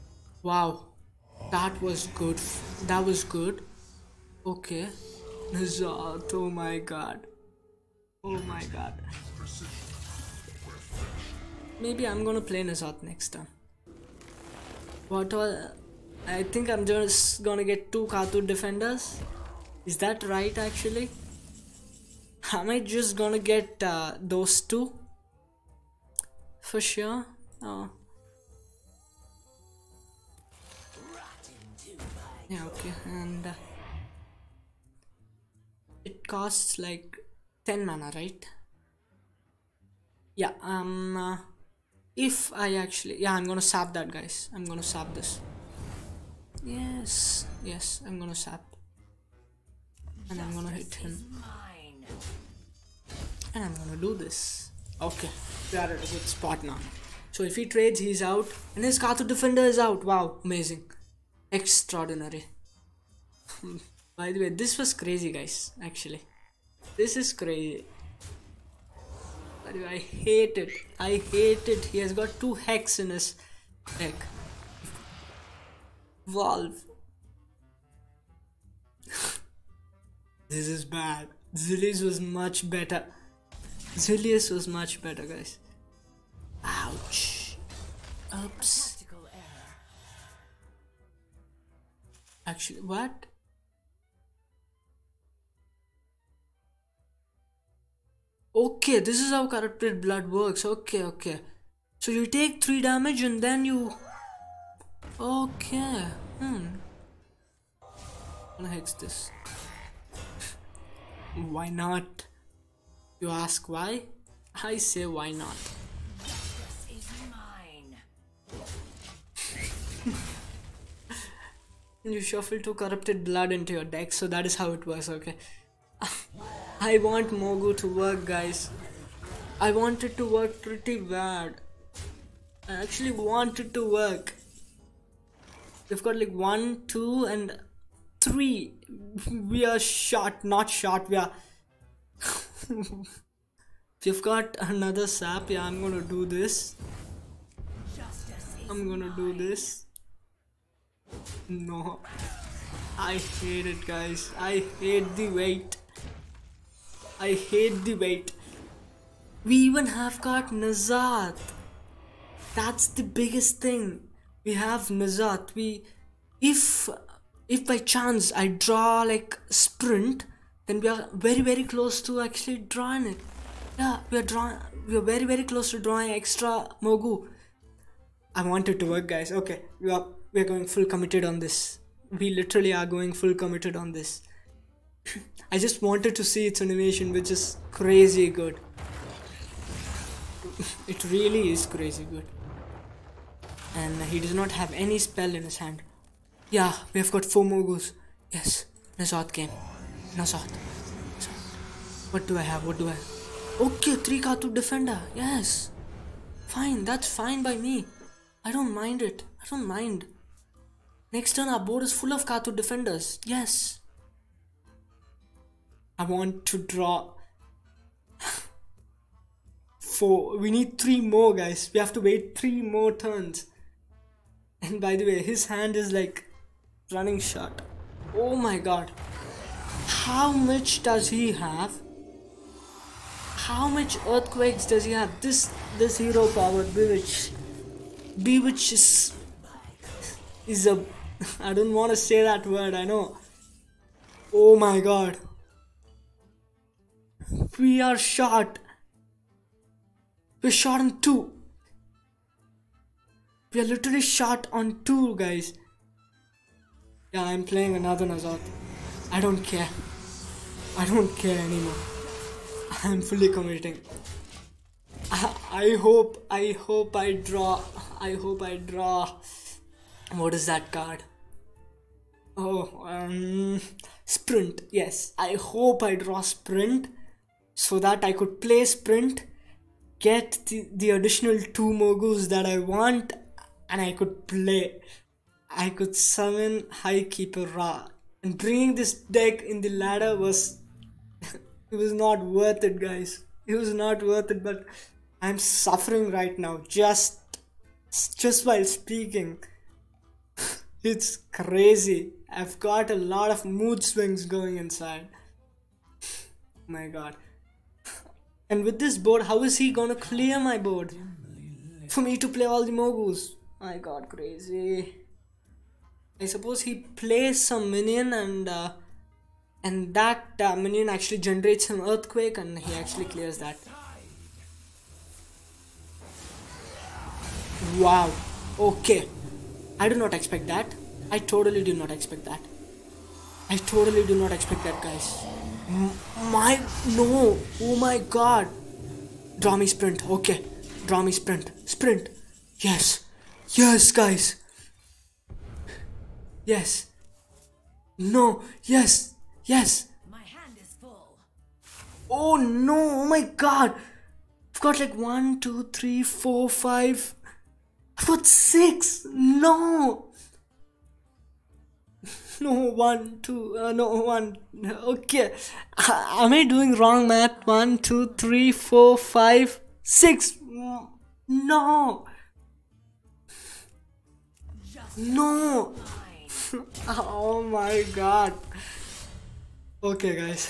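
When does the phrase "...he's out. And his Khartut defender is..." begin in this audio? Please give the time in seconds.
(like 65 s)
57 s.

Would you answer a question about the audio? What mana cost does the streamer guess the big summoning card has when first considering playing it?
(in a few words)
10.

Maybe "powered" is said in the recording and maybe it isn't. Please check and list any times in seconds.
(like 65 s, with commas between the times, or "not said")
236 s.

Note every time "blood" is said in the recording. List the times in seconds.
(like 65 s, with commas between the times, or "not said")
99 s, 123 s.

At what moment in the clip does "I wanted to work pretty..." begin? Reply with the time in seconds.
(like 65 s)
129 s.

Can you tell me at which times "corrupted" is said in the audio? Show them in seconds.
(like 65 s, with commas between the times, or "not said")
99 s, 122 s.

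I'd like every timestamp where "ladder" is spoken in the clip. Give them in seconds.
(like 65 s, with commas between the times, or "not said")
289 s.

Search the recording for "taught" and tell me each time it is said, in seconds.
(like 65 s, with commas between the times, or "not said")
not said.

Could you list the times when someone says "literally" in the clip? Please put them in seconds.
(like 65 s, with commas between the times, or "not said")
182 s, 253 s.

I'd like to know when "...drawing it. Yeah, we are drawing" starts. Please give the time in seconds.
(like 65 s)
172 s.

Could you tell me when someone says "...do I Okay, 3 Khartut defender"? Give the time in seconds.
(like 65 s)
202 s.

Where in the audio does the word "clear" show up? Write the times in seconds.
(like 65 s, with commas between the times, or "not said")
309 s, 323 s.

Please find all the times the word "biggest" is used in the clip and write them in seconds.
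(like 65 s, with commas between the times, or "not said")
163 s.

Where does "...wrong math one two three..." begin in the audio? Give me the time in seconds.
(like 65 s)
366 s.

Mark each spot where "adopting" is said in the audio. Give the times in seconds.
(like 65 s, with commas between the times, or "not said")
not said.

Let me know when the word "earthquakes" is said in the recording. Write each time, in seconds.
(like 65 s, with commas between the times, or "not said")
234 s, 321 s.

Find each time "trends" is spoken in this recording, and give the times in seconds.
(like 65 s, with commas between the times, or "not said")
not said.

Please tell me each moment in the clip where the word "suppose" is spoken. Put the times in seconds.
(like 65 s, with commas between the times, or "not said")
316 s.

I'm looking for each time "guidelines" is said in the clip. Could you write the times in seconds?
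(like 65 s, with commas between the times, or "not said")
not said.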